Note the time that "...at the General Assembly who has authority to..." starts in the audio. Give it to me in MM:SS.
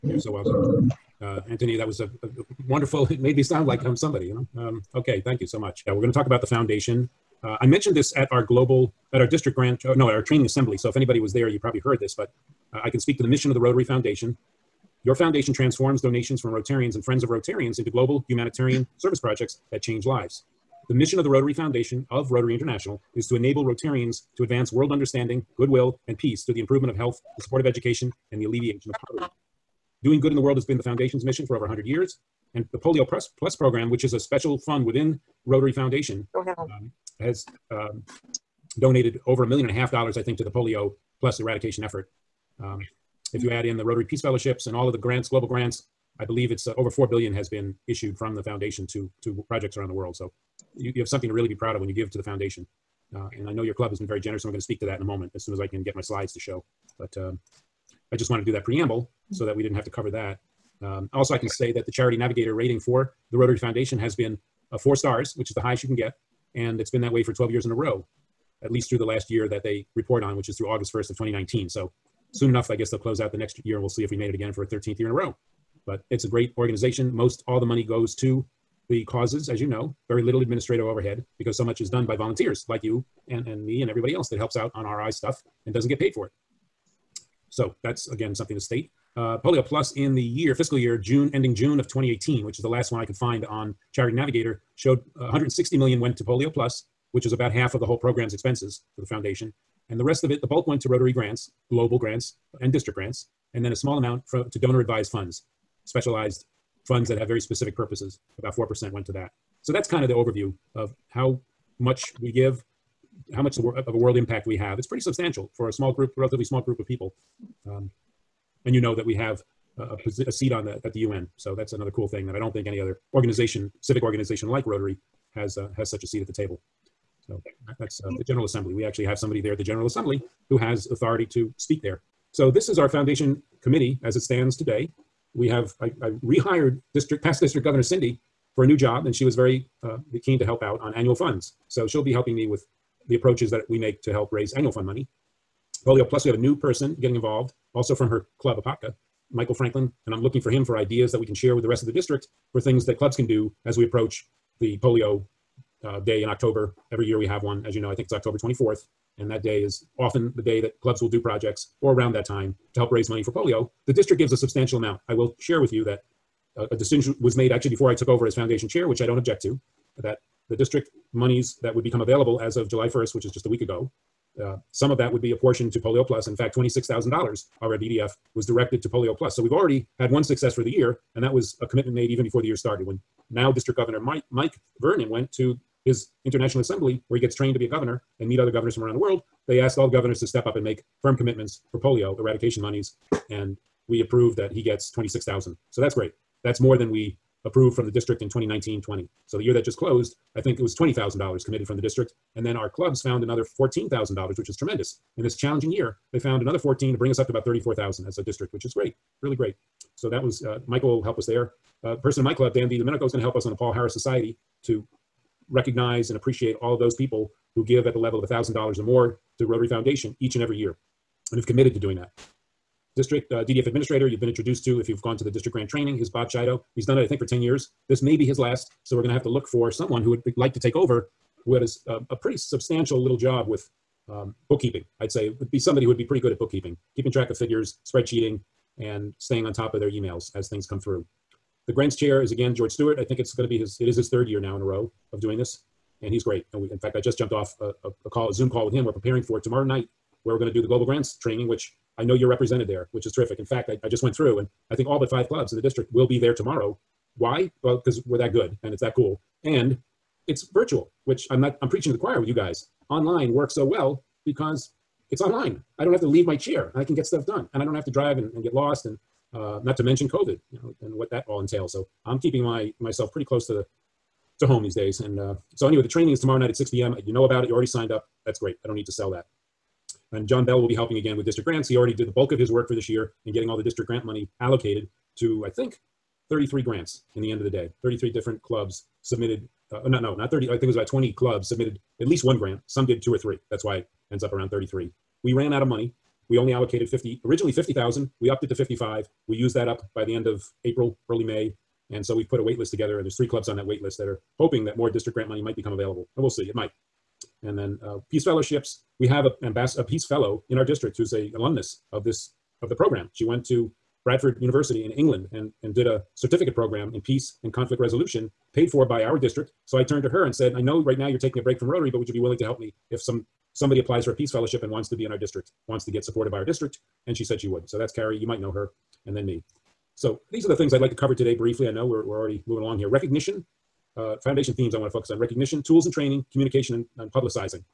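02:09.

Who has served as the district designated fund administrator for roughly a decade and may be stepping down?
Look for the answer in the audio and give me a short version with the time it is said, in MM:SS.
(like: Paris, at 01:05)
Bob Chido, at 03:46.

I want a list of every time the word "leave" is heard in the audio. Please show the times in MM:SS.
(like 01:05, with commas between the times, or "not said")
04:26.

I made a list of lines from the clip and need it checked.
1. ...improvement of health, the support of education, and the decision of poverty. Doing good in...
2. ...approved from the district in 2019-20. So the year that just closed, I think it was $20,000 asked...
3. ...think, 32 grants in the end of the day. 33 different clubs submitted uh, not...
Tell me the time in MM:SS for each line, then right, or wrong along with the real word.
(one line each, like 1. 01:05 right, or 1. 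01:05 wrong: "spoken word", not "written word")
1. 00:26 wrong: "alleviation", not "decision"
2. 03:17 wrong: "committed", not "asked"
3. 04:45 wrong: "33", not "32".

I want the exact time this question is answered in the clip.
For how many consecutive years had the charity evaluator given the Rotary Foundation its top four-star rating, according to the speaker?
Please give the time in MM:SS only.
01:07.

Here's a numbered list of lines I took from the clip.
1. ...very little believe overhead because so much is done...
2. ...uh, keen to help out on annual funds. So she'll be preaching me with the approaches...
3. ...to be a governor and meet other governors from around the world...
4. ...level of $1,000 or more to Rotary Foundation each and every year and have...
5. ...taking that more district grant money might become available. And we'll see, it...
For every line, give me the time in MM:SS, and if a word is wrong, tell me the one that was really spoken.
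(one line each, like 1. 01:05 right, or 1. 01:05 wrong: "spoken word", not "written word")
1. 01:20 wrong: "administrative", not "believe"
2. 02:19 wrong: "helping", not "preaching"
3. 03:07 right
4. 03:37 right
5. 05:04 wrong: "hoping", not "taking".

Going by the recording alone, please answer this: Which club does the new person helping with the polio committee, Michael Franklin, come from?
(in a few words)
Apopka.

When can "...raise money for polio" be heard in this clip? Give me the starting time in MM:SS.
02:42.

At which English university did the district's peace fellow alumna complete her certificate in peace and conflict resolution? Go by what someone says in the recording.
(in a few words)
Bradford University.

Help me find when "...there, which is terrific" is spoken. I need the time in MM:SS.
04:12.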